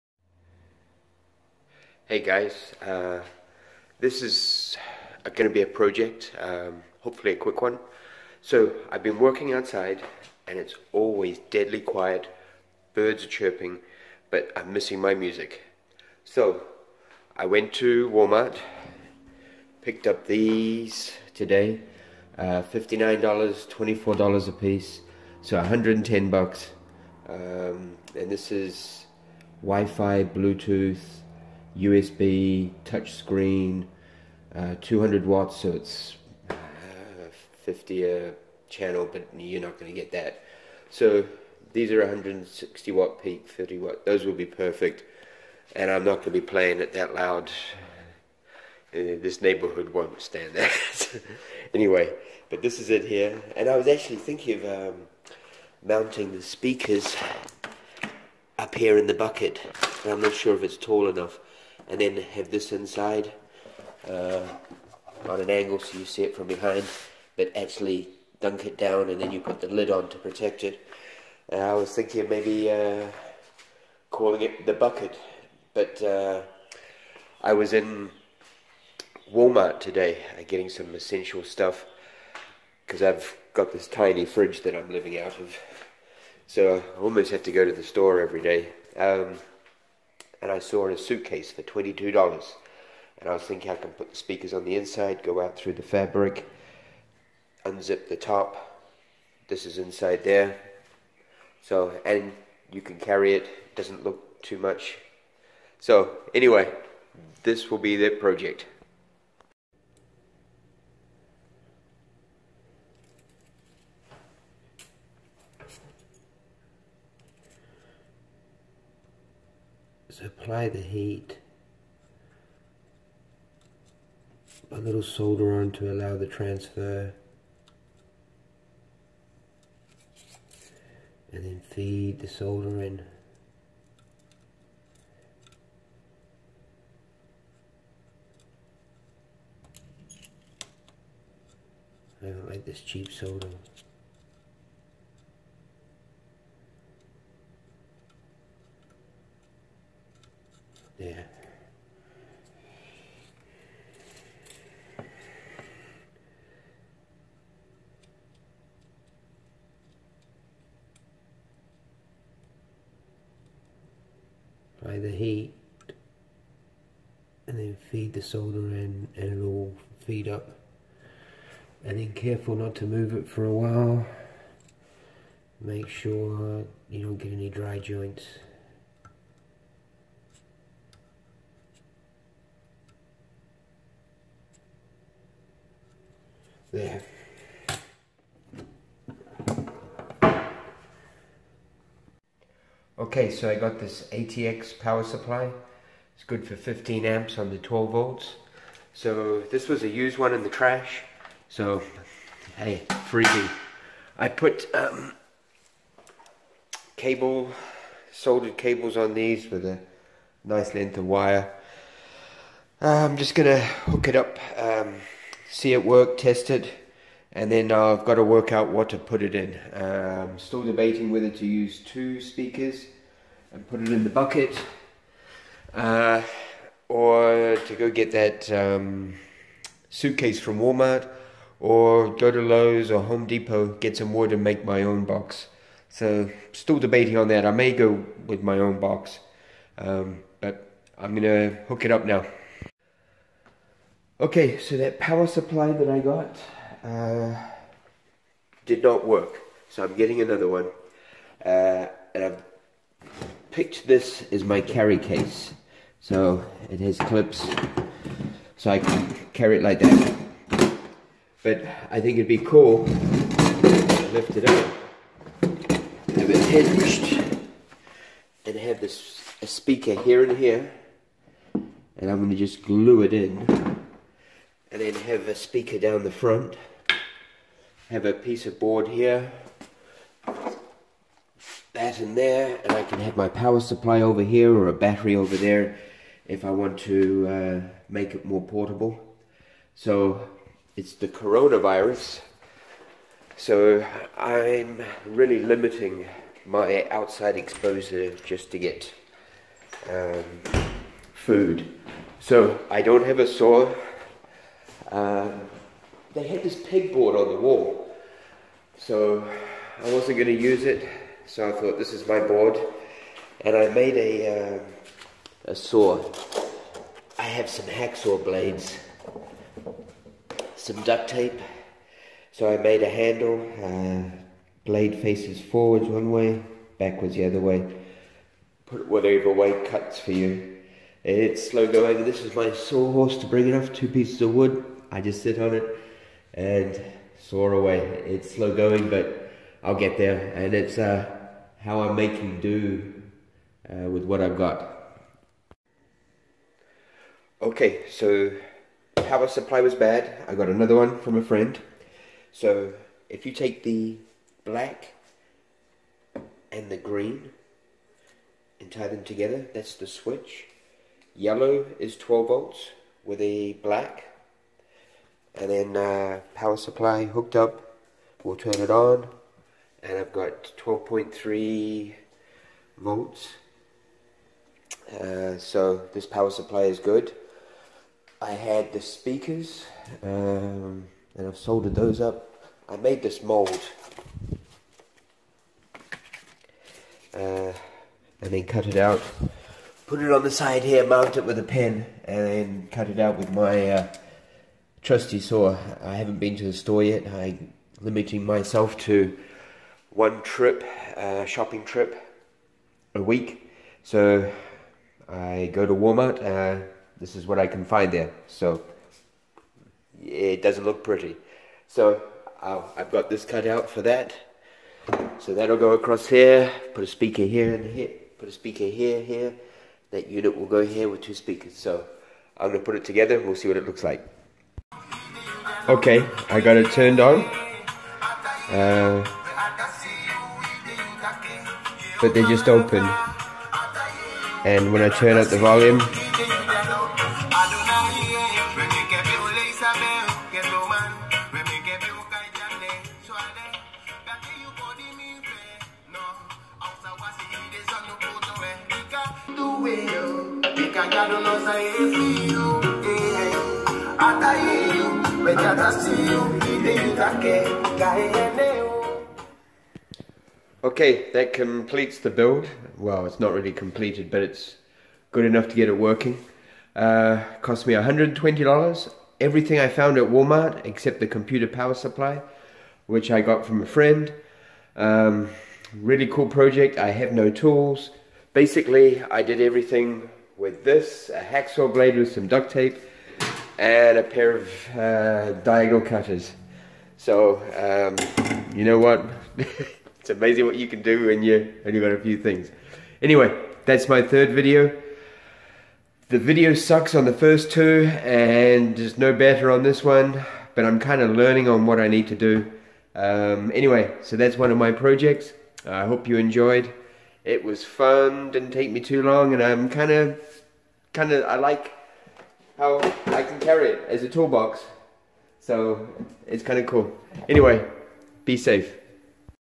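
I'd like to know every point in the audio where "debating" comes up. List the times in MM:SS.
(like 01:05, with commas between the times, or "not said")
03:40, 03:56.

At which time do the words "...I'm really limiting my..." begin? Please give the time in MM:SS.
04:54.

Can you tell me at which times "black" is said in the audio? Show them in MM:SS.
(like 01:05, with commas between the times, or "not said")
05:54, 06:03.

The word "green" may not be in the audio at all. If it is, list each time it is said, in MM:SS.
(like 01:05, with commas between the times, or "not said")
05:56.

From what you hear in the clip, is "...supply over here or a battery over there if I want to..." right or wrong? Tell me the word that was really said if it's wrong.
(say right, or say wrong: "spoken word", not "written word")
right.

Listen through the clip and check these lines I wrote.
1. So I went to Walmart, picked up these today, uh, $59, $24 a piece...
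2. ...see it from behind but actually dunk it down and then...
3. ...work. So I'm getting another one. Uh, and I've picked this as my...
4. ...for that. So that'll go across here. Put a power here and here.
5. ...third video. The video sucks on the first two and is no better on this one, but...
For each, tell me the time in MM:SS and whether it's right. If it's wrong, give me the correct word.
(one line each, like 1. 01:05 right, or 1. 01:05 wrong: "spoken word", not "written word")
1. 00:16 right
2. 01:06 right
3. 04:09 right
4. 06:53 wrong: "speaker", not "power"
5. 08:14 right.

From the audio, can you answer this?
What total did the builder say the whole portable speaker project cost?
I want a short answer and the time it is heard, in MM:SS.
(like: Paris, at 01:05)
$120, at 07:47.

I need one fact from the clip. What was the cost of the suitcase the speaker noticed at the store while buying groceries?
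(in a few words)
$22.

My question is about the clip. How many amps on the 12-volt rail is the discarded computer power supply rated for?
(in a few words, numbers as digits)
15 amps.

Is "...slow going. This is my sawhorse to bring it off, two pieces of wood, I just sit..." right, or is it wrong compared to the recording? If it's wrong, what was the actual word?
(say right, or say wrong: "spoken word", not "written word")
right.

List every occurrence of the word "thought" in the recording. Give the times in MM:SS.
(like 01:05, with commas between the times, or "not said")
05:11.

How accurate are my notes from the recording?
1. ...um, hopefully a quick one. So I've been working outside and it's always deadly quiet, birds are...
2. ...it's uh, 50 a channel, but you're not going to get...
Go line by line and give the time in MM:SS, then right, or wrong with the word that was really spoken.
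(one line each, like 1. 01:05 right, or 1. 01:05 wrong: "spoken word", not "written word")
1. 00:06 right
2. 00:35 right.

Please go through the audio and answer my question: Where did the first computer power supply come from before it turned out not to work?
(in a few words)
the trash.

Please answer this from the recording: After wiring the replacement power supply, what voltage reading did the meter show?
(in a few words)
12.3 volts.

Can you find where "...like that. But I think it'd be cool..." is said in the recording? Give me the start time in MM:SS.
04:19.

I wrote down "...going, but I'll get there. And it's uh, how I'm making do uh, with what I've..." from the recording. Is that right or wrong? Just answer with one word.
right.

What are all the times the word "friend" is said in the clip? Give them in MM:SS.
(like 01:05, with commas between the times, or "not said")
05:51, 07:53.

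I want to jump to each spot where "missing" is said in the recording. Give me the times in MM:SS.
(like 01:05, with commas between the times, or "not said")
00:14.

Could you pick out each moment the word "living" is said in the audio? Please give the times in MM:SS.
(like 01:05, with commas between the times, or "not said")
01:24.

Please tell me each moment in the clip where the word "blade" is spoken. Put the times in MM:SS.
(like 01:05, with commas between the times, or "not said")
05:18, 05:24, 08:01.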